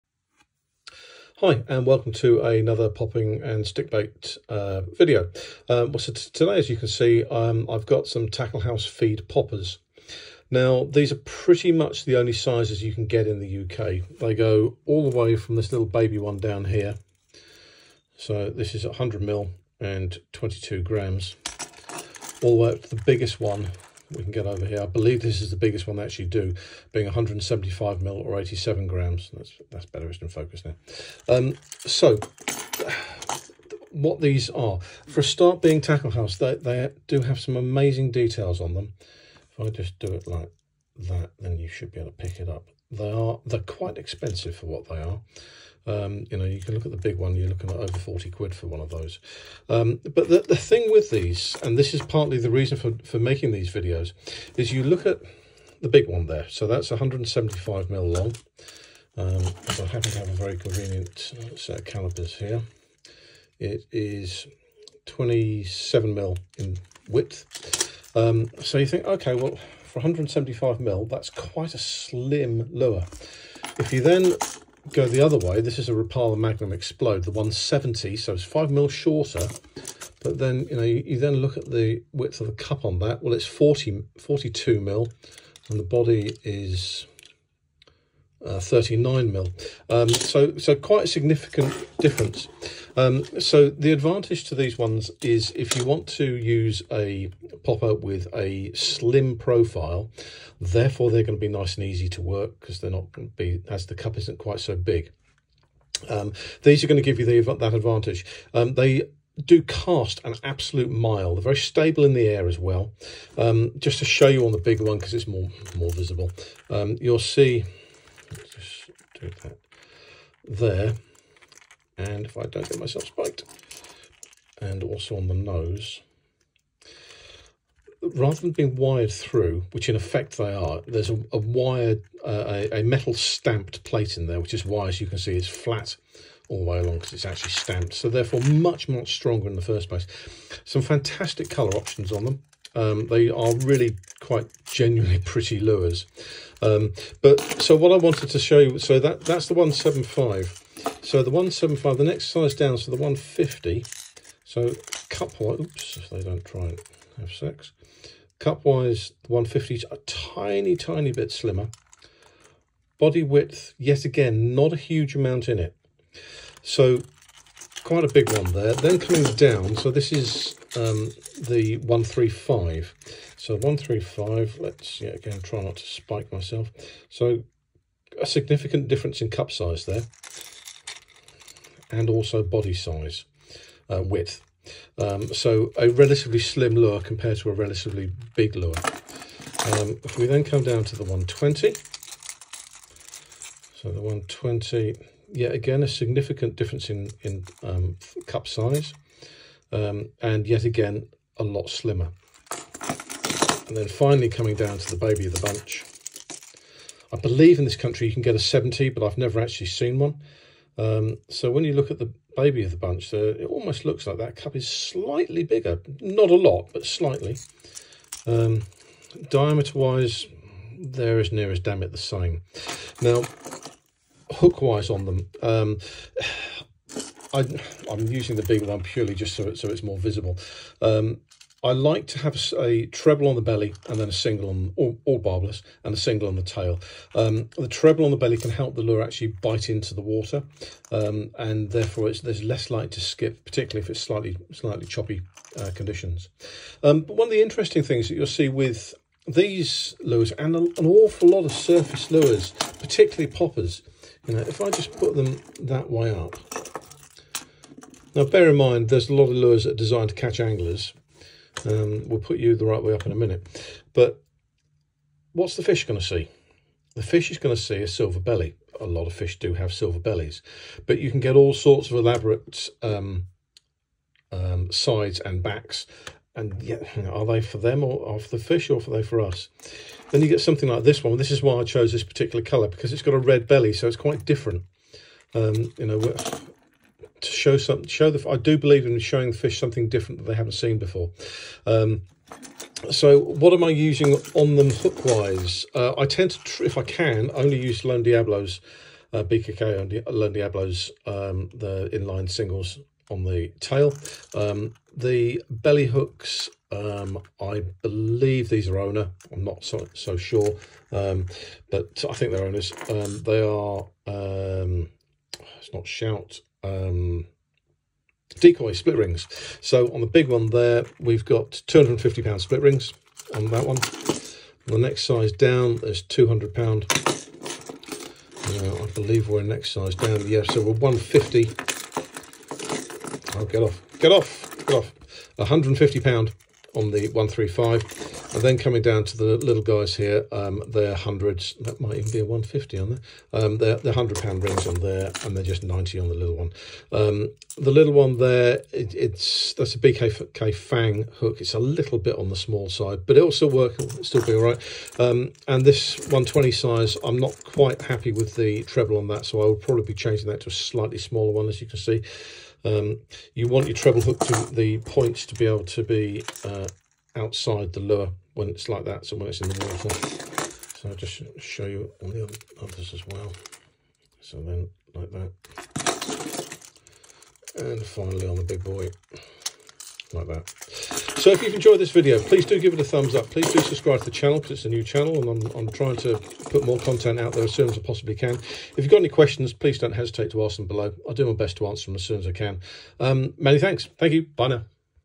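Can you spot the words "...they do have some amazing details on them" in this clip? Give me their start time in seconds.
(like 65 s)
36 s.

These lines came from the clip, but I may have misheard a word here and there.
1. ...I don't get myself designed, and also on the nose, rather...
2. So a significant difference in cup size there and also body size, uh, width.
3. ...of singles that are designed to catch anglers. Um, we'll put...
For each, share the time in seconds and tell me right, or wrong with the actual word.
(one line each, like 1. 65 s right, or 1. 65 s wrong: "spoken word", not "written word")
1. 122 s wrong: "spiked", not "designed"
2. 177 s right
3. 259 s wrong: "lures", not "singles".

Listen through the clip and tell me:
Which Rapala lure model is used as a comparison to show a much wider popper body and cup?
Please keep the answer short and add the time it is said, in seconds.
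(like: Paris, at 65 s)
Magnum Xplode, at 76 s.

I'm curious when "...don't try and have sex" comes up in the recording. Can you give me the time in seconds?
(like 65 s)
156 s.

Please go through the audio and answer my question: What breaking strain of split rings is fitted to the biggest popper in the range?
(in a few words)
250 pound.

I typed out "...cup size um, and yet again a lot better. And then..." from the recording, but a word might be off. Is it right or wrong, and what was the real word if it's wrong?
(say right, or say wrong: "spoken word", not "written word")
wrong: "slimmer", not "better".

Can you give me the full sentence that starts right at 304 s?
Um, the belly hooks, um, I believe these are owner.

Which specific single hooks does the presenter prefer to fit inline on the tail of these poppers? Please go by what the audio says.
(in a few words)
BKK Lone Diablos.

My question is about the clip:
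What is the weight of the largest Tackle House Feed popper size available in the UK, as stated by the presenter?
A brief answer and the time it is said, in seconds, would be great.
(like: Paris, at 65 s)
87 grams, at 28 s.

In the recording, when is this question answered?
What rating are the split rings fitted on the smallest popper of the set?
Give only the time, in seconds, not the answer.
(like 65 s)
345 s.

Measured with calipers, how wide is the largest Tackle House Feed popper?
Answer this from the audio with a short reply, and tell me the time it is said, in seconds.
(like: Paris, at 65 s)
27 mm, at 65 s.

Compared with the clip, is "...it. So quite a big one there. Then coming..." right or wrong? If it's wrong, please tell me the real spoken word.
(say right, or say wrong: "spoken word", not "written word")
right.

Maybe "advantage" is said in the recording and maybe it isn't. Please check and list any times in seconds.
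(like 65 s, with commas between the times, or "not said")
93 s, 107 s.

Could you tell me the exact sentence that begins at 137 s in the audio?
So therefore much, much stronger in the first place.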